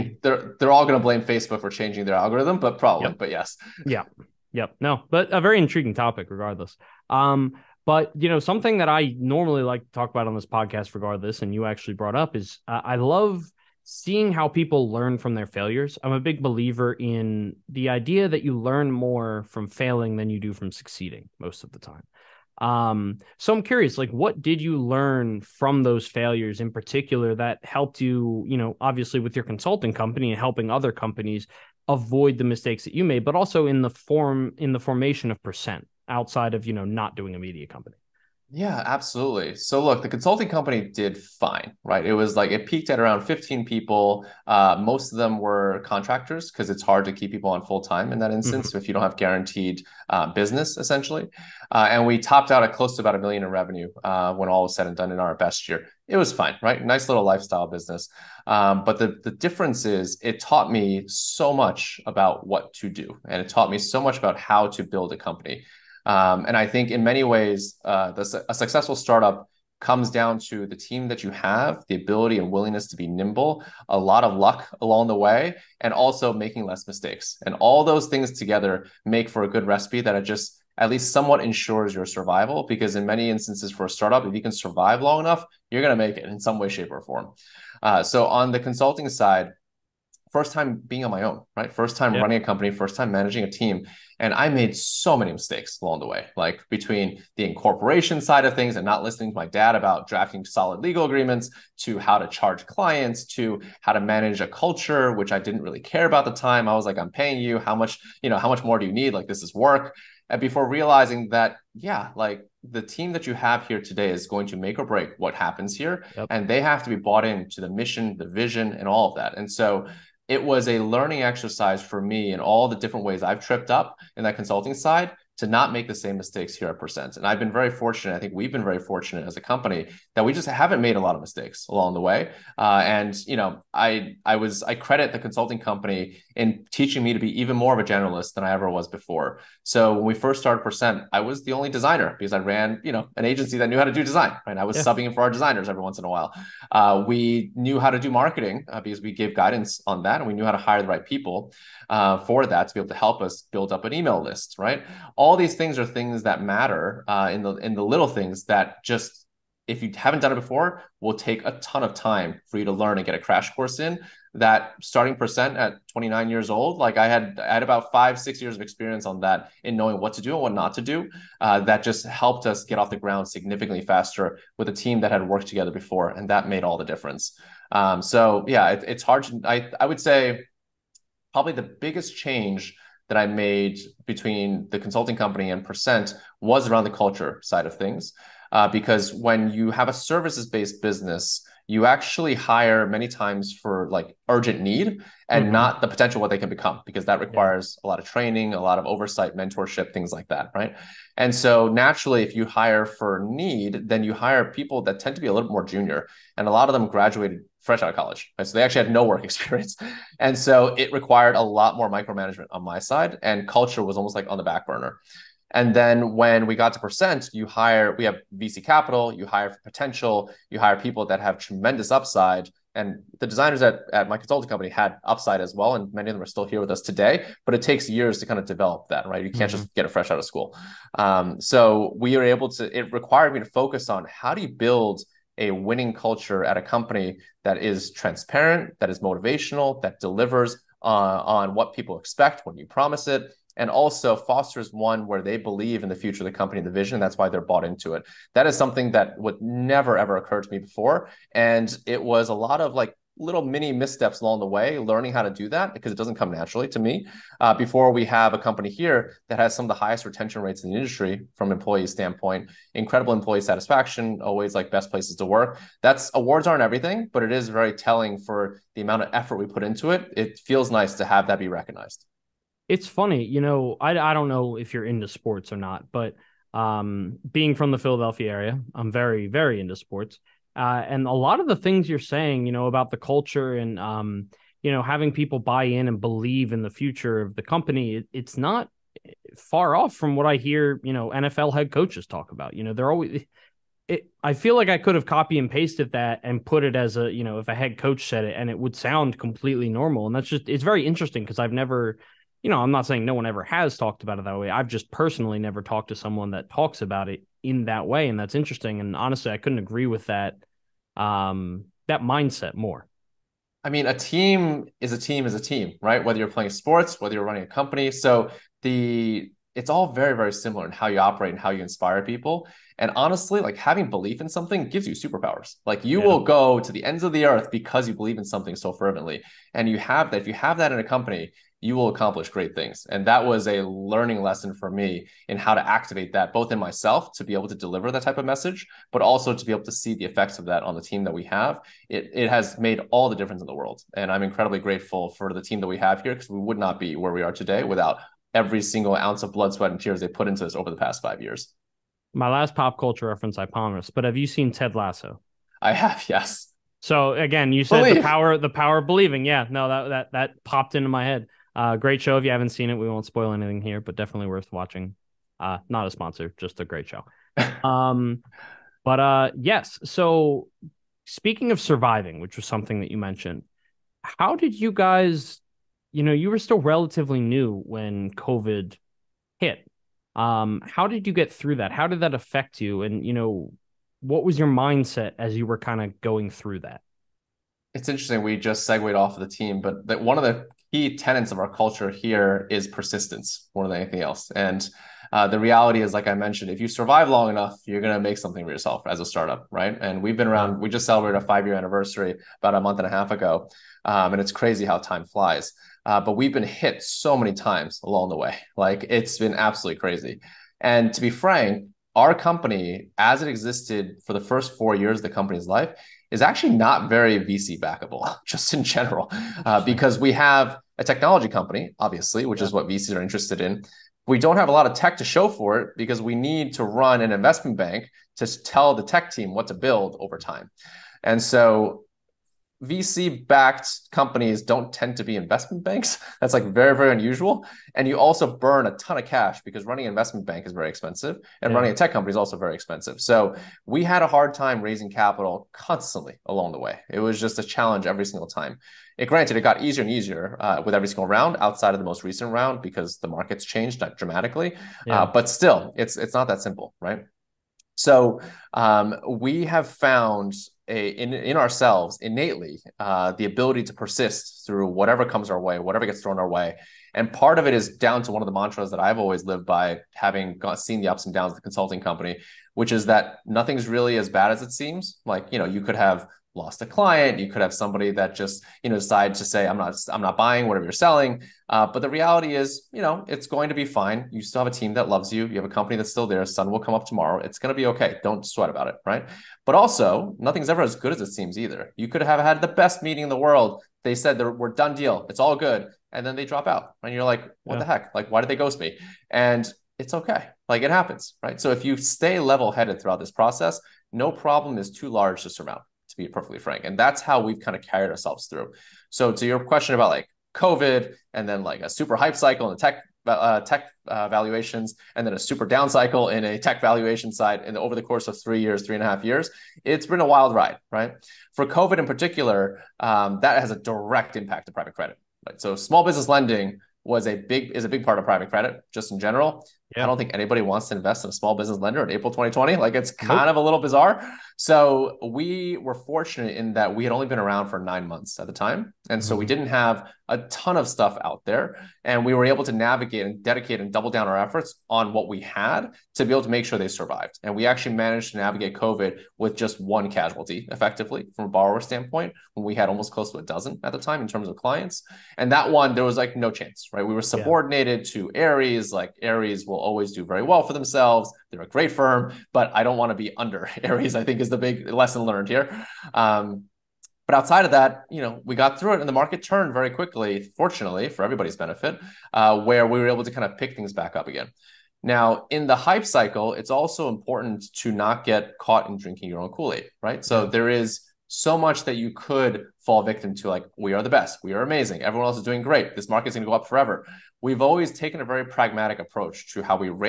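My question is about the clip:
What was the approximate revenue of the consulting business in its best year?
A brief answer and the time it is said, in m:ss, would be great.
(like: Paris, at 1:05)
About a million, at 0:52.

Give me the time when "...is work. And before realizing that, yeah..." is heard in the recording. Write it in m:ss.
1:49.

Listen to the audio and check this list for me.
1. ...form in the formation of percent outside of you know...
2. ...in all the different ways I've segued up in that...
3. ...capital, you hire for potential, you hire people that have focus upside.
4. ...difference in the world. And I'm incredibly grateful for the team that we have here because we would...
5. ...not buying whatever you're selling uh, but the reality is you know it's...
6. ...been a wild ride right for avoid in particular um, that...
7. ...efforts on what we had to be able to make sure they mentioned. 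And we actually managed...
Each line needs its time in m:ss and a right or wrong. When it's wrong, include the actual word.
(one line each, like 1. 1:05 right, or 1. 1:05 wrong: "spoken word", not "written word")
1. 0:33 right
2. 2:02 wrong: "tripped", not "segued"
3. 3:38 wrong: "tremendous", not "focus"
4. 5:43 right
5. 7:59 right
6. 8:39 wrong: "covid", not "avoid"
7. 9:04 wrong: "survived", not "mentioned".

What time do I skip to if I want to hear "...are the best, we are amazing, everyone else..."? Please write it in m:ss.
9:43.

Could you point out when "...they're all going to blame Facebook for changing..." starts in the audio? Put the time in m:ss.
0:00.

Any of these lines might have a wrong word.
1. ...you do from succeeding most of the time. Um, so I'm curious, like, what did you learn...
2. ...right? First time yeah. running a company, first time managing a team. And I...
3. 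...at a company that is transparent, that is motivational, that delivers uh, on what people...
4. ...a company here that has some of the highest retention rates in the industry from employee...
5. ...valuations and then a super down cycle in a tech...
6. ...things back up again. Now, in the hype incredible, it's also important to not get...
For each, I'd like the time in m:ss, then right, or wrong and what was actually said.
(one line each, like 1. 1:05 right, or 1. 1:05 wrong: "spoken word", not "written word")
1. 0:20 right
2. 1:31 right
3. 3:56 right
4. 4:18 right
5. 8:34 right
6. 9:33 wrong: "cycle", not "incredible".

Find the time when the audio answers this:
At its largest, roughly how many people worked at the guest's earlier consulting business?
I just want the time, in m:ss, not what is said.
0:43.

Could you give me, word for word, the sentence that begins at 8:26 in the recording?
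And that's how we've kind of carried ourselves through.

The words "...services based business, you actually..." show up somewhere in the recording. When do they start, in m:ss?
3:09.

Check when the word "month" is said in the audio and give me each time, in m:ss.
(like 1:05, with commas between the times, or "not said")
6:42, 8:57.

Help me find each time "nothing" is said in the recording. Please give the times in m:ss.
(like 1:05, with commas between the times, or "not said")
7:53, 8:10.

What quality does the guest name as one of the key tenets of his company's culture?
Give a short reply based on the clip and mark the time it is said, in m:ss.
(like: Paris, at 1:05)
Persistence, at 6:32.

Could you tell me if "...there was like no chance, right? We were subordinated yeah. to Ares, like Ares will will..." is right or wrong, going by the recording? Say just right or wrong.
right.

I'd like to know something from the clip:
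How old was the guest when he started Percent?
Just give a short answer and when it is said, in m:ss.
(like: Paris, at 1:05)
29, at 2:45.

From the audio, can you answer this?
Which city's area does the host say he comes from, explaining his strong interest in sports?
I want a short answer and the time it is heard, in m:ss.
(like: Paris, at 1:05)
Philadelphia, at 4:37.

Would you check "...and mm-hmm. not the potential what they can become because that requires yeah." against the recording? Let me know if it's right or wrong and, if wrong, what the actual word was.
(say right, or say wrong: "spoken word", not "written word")
right.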